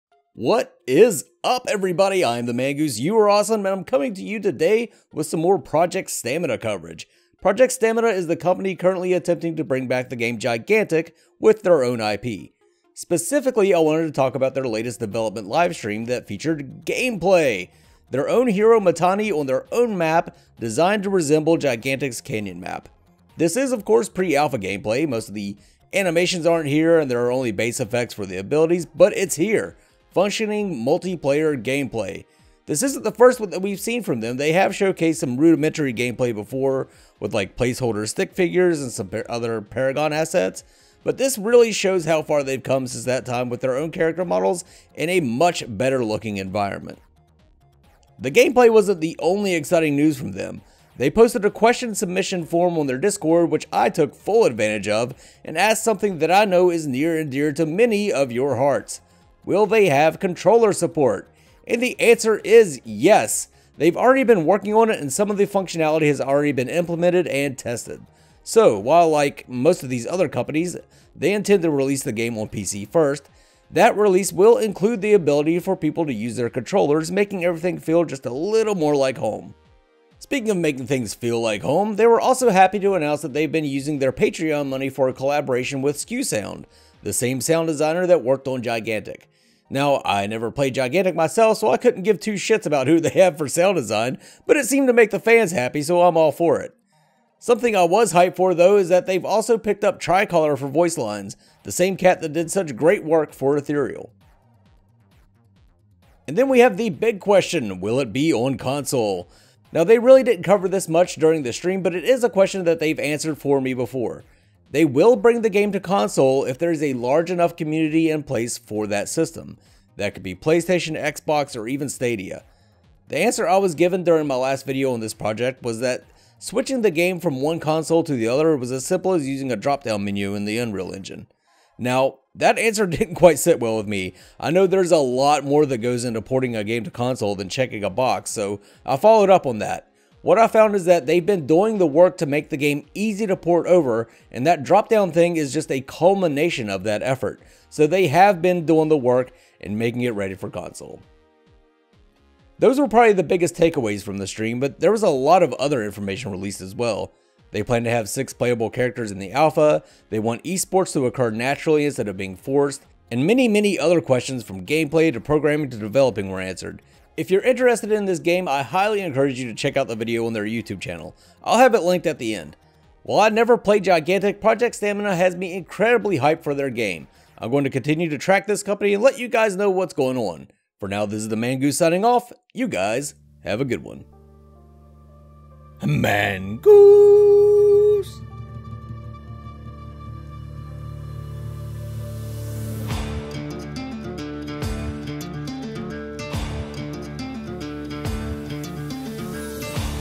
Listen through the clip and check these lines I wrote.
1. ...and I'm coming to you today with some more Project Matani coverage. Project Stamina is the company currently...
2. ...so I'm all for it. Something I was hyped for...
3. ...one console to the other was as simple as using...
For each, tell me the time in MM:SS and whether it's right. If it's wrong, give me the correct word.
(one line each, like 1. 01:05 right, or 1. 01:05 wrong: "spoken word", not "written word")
1. 00:03 wrong: "Stamina", not "Matani"
2. 01:35 right
3. 02:07 right.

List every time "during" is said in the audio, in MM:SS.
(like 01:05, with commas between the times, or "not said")
01:51, 02:04.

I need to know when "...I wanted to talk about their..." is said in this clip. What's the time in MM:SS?
00:13.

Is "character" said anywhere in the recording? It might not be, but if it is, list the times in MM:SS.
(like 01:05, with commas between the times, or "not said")
00:43, 02:38.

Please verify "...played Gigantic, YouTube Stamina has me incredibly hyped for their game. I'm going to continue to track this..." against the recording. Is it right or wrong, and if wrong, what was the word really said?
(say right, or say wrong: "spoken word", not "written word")
wrong: "Project", not "YouTube".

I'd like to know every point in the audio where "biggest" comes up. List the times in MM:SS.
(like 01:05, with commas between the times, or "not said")
02:33.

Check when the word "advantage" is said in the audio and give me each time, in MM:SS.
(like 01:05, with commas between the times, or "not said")
00:54.